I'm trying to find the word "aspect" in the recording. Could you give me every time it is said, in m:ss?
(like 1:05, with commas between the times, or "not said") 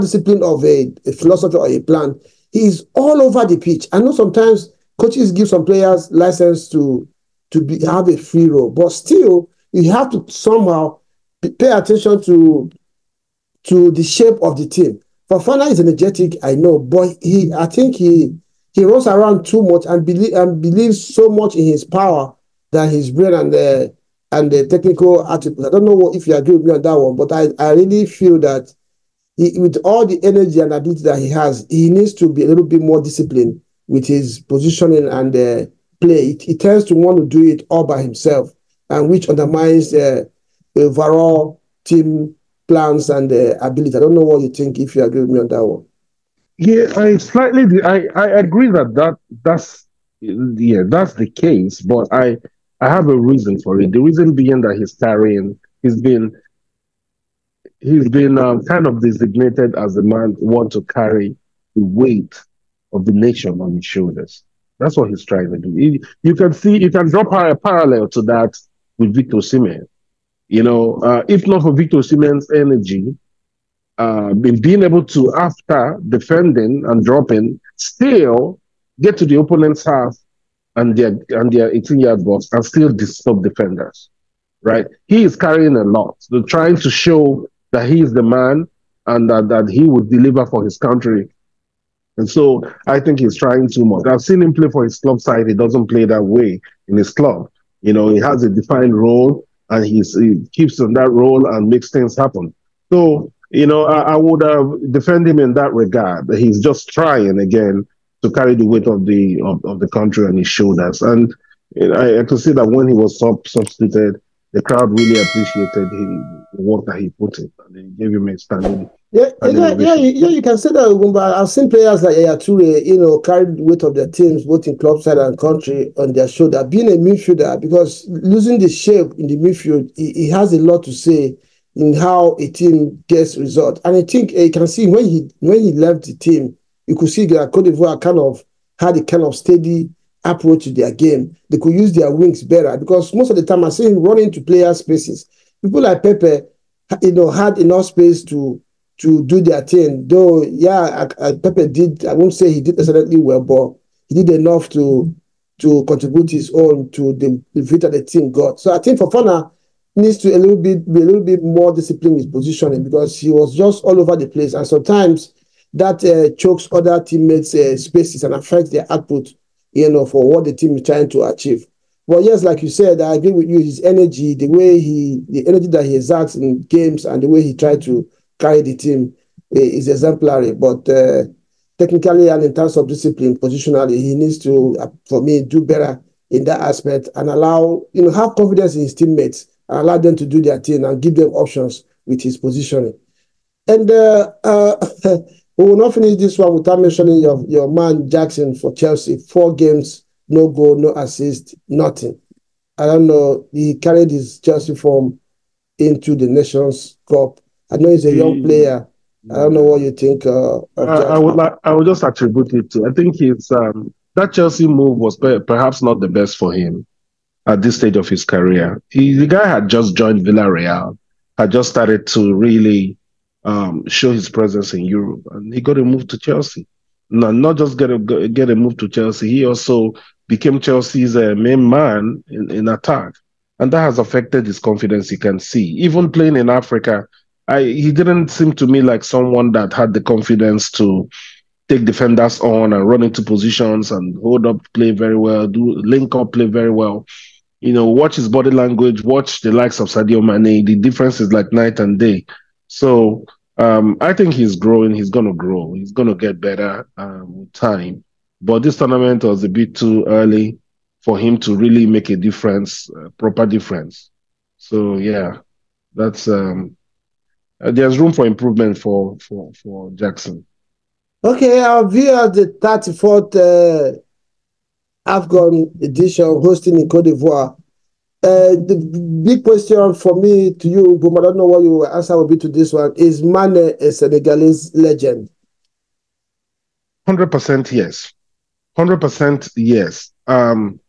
3:06.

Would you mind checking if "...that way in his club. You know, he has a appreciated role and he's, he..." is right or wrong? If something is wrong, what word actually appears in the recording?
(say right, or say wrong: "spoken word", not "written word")
wrong: "defined", not "appreciated".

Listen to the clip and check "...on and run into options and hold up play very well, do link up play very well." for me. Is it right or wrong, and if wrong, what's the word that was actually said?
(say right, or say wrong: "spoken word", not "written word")
wrong: "positions", not "options".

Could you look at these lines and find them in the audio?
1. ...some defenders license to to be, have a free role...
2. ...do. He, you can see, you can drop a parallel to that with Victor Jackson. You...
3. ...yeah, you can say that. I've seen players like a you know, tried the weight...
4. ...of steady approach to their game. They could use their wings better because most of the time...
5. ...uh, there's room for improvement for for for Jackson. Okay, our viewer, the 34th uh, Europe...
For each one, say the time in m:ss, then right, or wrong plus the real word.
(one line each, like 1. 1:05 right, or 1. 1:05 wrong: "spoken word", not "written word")
1. 0:05 wrong: "players", not "defenders"
2. 1:05 wrong: "Osimhen", not "Jackson"
3. 2:00 wrong: "carried", not "tried"
4. 2:19 right
5. 4:27 wrong: "AFCON", not "Europe".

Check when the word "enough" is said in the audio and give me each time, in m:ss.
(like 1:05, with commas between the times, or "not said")
2:27, 2:34.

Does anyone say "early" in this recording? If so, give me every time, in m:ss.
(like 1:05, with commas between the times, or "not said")
4:20.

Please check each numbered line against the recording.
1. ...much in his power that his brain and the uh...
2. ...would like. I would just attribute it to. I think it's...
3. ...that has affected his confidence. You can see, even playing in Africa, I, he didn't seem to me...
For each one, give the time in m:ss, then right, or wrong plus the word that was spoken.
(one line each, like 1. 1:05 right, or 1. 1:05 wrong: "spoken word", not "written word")
1. 0:21 right
2. 3:31 right
3. 3:53 right.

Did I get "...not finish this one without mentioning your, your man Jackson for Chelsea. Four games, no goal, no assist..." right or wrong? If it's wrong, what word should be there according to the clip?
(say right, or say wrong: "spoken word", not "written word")
right.